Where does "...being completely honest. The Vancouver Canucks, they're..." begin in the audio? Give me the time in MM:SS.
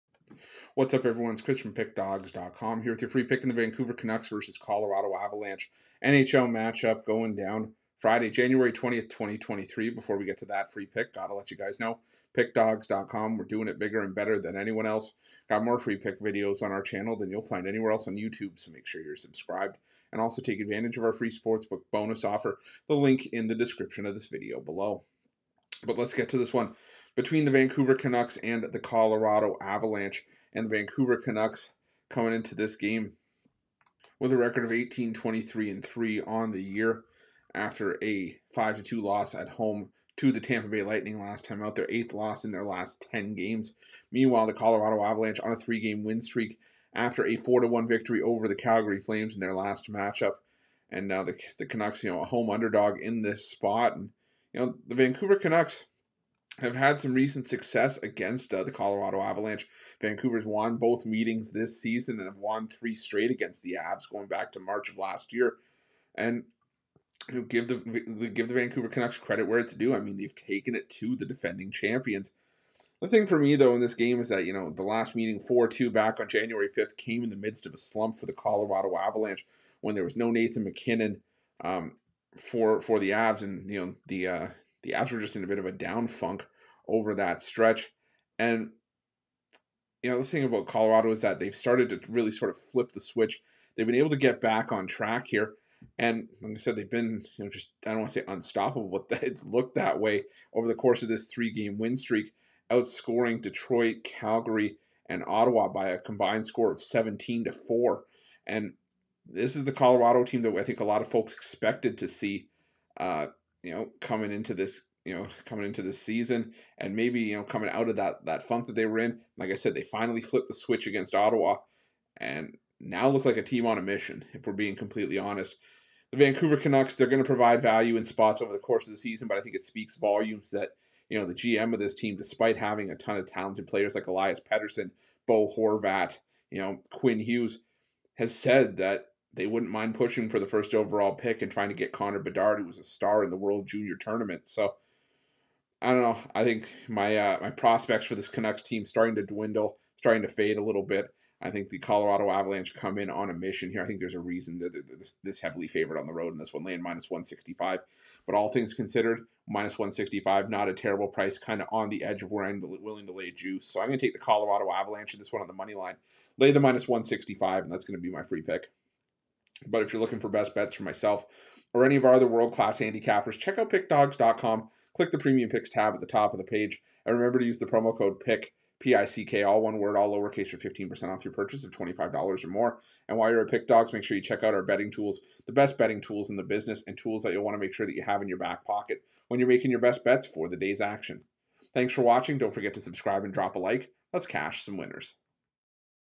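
02:04.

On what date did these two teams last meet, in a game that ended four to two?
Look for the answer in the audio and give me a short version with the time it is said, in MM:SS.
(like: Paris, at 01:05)
January 5th, at 01:16.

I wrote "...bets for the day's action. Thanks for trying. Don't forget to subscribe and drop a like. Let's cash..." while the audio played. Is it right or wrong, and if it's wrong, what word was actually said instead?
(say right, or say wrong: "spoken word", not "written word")
wrong: "watching", not "trying".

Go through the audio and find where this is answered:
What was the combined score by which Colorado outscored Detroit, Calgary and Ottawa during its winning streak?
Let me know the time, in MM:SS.
01:46.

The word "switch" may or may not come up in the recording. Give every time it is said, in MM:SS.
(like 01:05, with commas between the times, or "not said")
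01:33, 02:00.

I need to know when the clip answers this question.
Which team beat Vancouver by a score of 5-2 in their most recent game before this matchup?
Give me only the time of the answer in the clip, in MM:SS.
00:40.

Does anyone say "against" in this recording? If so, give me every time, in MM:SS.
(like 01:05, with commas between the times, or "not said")
00:57, 01:03, 02:00.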